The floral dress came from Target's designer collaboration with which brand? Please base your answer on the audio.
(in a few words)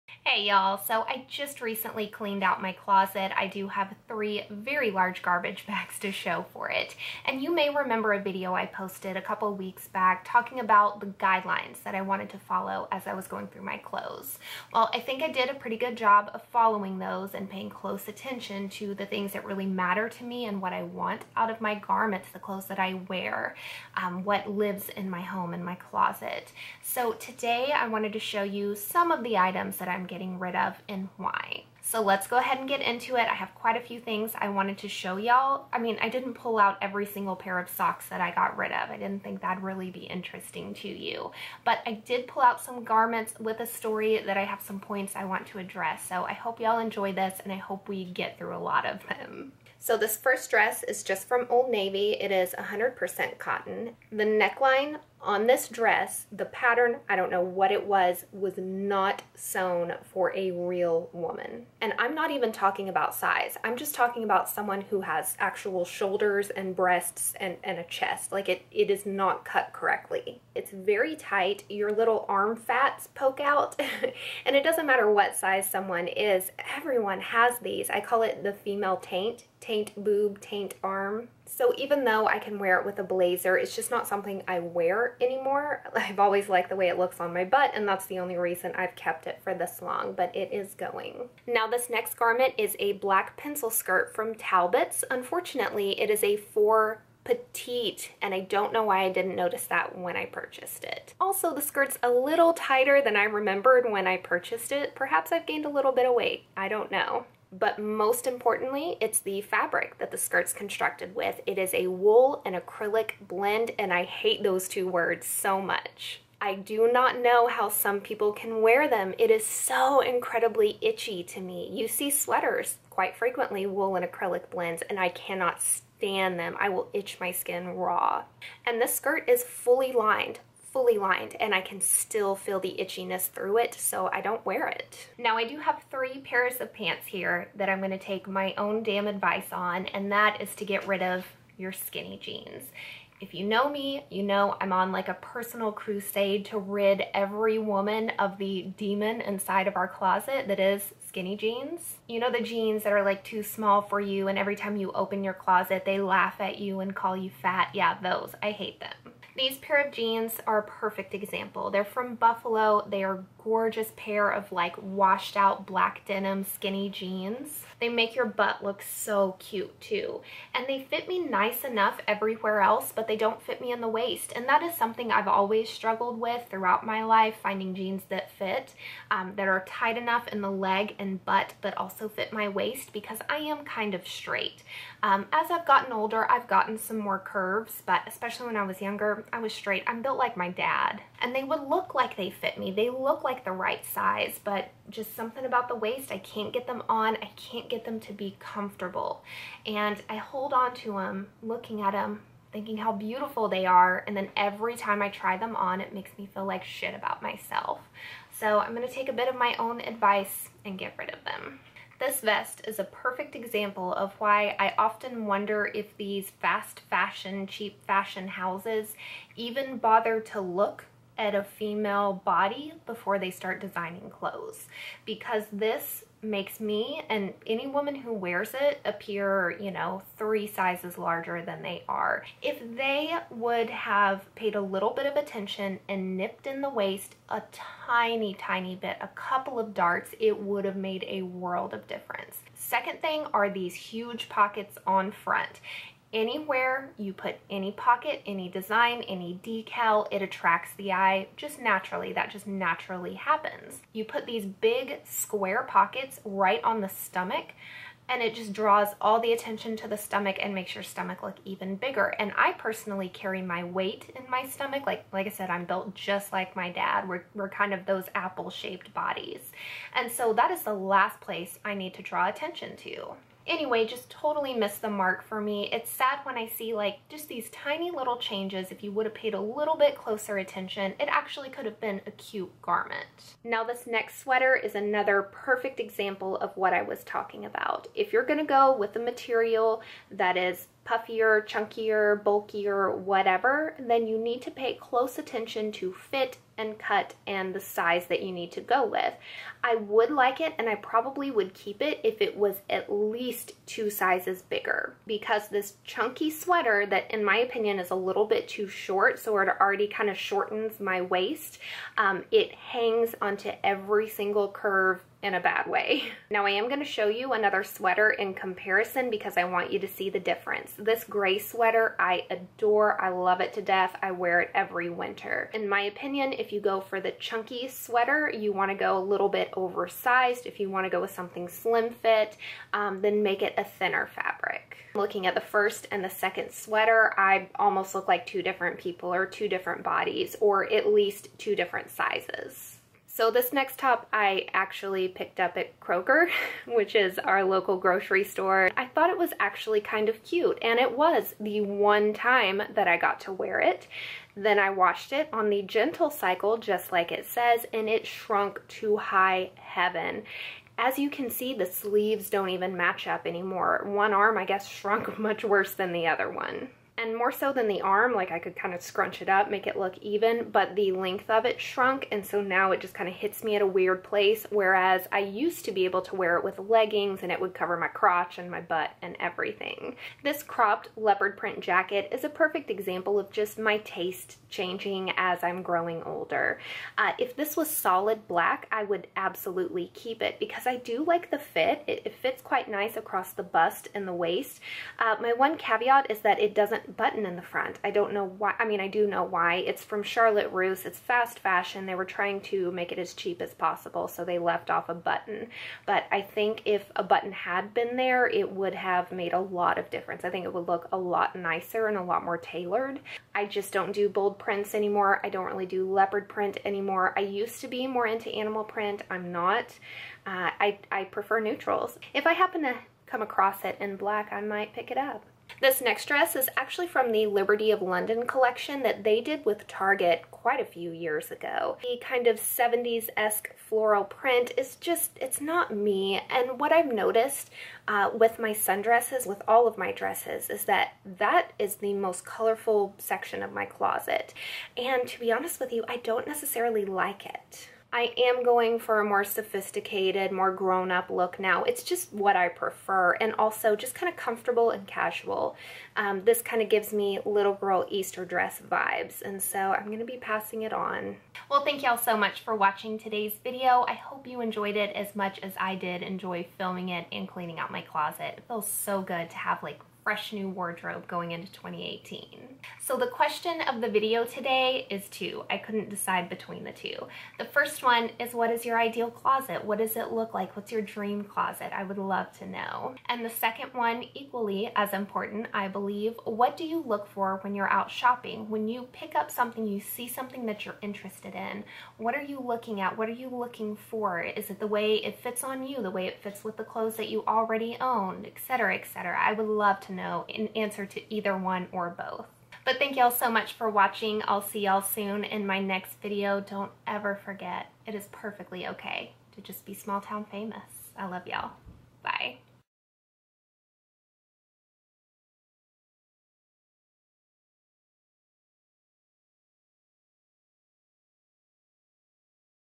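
Liberty of London.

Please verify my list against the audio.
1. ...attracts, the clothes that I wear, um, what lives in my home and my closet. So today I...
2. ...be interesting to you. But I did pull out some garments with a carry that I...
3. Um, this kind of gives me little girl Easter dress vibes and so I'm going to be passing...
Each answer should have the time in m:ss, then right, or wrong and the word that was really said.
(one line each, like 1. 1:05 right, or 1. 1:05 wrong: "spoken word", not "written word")
1. 0:21 wrong: "garments", not "attracts"
2. 0:39 wrong: "story", not "carry"
3. 7:35 right.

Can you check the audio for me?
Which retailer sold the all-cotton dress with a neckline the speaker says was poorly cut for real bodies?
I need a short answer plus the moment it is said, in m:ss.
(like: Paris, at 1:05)
Old Navy, at 0:51.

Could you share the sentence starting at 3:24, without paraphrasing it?
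And then every time I try them on, it makes me feel like shit about myself.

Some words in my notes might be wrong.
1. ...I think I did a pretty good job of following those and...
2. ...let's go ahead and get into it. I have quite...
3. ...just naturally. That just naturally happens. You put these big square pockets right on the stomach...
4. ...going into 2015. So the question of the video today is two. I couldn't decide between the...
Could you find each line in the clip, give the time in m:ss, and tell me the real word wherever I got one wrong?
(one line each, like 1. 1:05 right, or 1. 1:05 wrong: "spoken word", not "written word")
1. 0:14 right
2. 0:32 right
3. 4:11 right
4. 7:51 wrong: "2018", not "2015".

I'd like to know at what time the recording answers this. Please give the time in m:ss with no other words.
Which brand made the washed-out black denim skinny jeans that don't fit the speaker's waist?
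2:42.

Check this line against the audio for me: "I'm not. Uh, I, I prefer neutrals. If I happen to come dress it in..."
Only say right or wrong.
wrong.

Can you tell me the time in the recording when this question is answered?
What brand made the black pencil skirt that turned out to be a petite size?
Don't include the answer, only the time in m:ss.
1:34.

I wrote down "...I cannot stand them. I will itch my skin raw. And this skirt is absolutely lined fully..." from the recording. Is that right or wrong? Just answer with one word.
wrong.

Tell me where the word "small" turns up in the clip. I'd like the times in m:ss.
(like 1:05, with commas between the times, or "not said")
2:33, 8:29.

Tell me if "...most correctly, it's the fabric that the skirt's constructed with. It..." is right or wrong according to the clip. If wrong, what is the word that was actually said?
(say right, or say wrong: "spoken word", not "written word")
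wrong: "importantly", not "correctly".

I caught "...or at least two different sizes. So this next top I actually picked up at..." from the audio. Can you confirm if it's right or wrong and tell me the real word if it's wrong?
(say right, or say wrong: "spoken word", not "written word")
right.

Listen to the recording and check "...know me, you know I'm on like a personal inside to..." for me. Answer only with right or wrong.
wrong.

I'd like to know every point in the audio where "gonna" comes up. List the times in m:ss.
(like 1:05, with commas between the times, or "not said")
2:17, 4:48, 5:16.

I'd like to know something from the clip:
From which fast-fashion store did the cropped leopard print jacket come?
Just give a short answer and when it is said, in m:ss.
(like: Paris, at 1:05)
Charlotte Russe, at 6:40.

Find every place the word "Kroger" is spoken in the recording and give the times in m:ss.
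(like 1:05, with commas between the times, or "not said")
5:45.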